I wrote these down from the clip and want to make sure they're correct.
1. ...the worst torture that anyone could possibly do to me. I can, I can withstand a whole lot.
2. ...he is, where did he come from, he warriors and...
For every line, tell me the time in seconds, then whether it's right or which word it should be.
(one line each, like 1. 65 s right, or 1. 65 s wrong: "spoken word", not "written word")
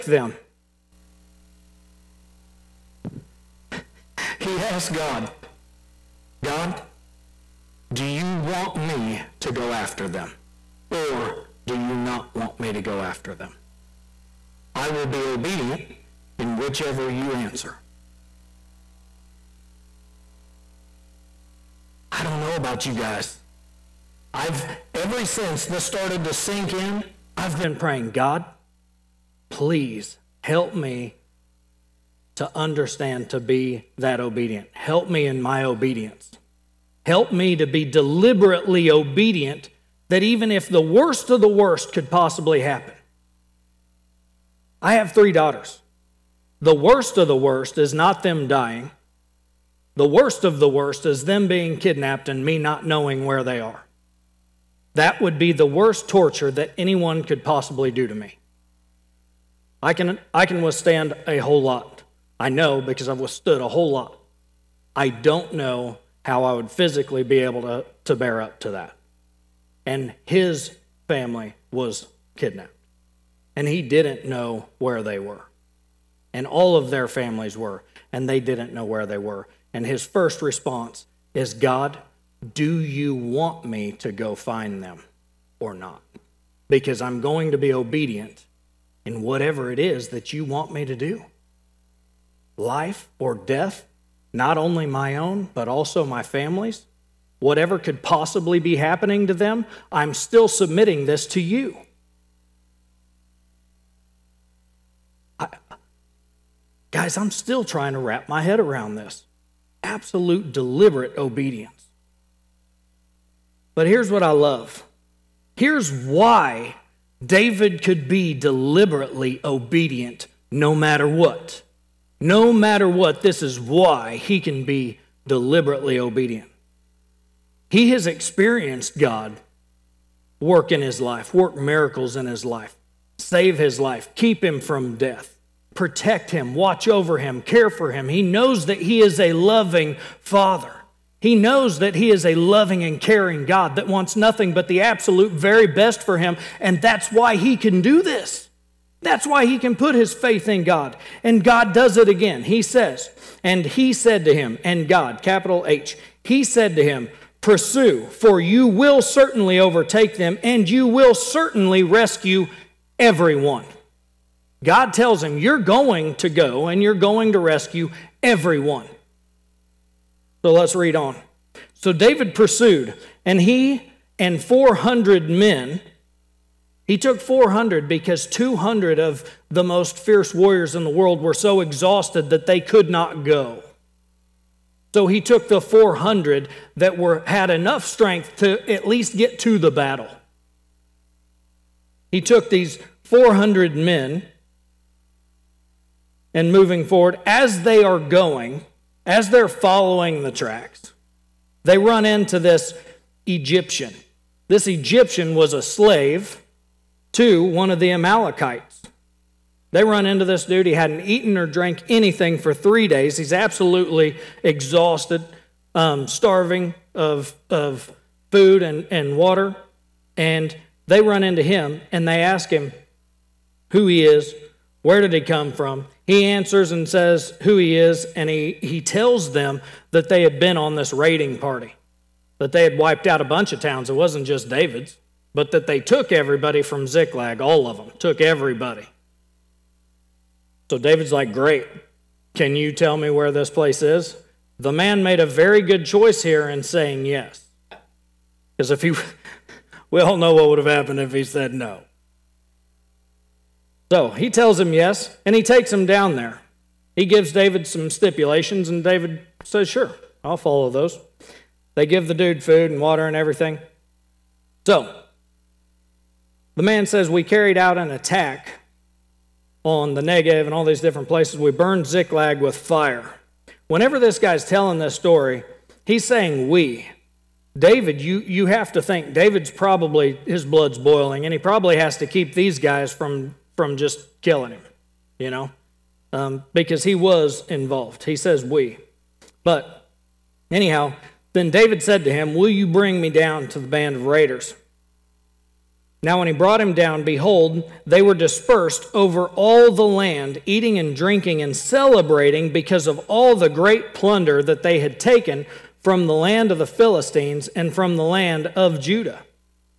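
1. 55 s right
2. 223 s wrong: "answers", not "warriors".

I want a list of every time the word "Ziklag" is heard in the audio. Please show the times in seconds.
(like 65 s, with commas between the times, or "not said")
236 s, 271 s.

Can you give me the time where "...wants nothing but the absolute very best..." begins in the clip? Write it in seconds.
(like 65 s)
143 s.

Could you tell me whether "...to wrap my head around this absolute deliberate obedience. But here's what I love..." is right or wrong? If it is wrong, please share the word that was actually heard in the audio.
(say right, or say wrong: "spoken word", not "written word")
right.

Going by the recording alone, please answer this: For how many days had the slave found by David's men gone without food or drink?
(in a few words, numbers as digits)
3.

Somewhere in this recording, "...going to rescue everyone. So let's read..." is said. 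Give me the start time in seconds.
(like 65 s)
166 s.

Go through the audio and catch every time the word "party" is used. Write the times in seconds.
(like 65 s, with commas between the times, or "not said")
231 s.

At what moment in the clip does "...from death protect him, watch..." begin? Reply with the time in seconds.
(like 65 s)
134 s.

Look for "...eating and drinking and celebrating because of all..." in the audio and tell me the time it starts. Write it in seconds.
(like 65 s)
300 s.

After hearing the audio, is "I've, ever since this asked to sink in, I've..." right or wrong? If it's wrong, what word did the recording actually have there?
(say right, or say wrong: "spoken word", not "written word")
wrong: "started", not "asked".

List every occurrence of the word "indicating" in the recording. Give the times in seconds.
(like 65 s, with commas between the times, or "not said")
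not said.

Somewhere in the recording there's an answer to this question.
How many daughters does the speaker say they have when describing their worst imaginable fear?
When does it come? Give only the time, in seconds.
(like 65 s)
45 s.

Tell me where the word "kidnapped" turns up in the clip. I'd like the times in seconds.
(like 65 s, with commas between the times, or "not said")
51 s, 72 s.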